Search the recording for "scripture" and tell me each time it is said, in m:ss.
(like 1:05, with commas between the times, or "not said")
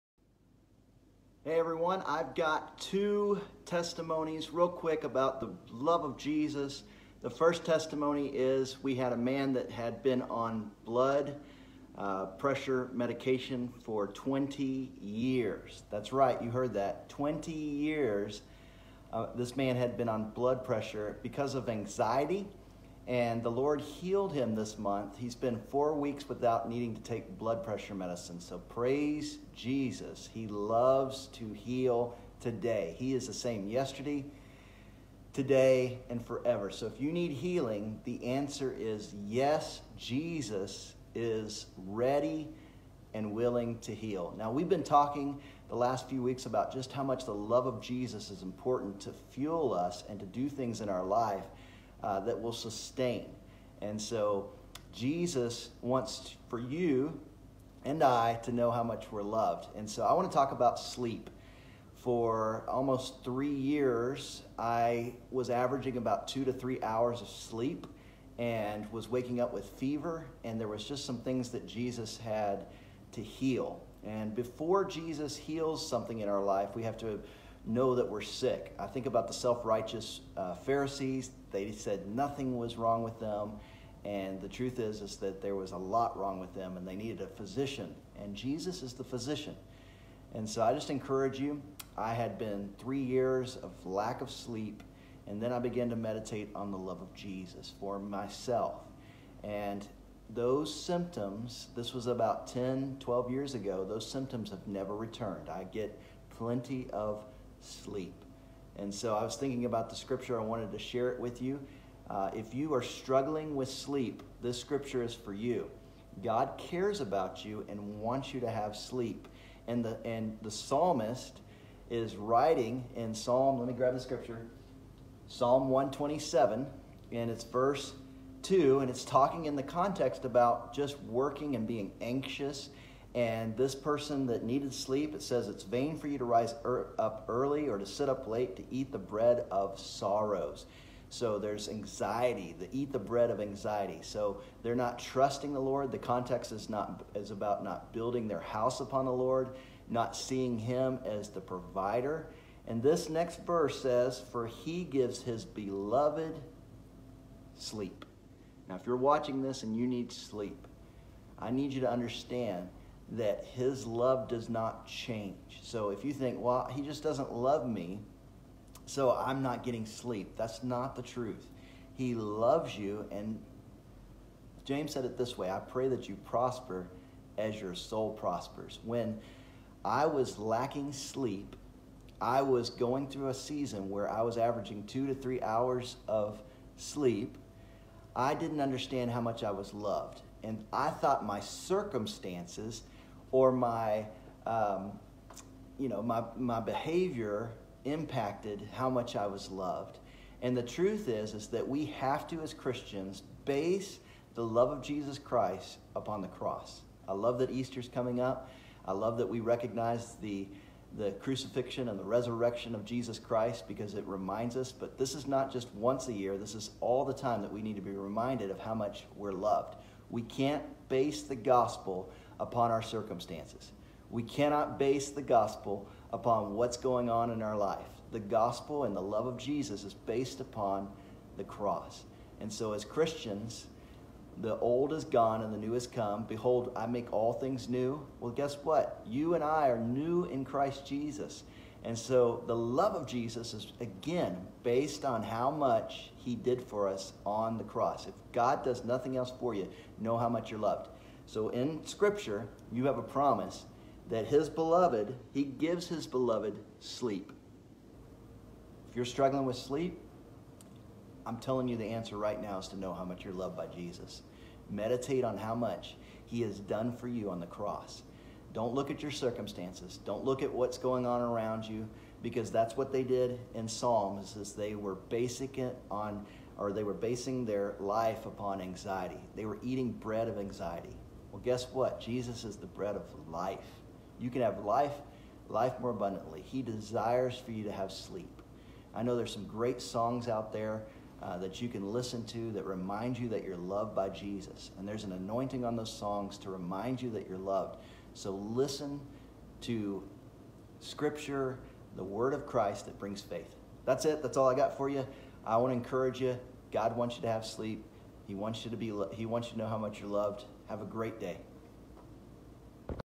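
1:49, 1:54, 2:03, 4:11, 5:00.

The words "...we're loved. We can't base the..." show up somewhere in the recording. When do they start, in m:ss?
3:39.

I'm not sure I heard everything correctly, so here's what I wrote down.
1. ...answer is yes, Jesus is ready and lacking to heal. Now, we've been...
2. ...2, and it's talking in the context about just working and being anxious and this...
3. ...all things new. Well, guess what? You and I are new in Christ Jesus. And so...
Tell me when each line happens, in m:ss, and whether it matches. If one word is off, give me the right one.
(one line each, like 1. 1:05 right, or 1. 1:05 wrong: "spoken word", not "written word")
1. 0:38 wrong: "willing", not "lacking"
2. 2:08 right
3. 3:57 right.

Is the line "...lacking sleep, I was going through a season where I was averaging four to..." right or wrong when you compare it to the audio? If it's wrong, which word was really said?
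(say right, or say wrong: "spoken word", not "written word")
wrong: "two", not "four".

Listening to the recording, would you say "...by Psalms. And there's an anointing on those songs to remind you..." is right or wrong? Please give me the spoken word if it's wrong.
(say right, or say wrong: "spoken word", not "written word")
wrong: "Jesus", not "Psalms".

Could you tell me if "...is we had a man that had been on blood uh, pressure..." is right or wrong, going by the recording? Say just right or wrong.
right.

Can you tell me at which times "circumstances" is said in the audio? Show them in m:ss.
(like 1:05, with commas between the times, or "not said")
3:11, 3:42, 4:29.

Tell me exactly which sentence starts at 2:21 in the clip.
So there's anxiety, the eat the bread of anxiety.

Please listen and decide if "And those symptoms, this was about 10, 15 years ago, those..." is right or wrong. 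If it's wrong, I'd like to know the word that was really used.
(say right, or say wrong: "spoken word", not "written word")
wrong: "12", not "15".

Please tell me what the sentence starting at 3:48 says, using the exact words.
The gospel and the love of Jesus is based upon the cross.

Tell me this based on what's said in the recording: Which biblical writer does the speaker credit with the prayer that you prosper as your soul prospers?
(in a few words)
James.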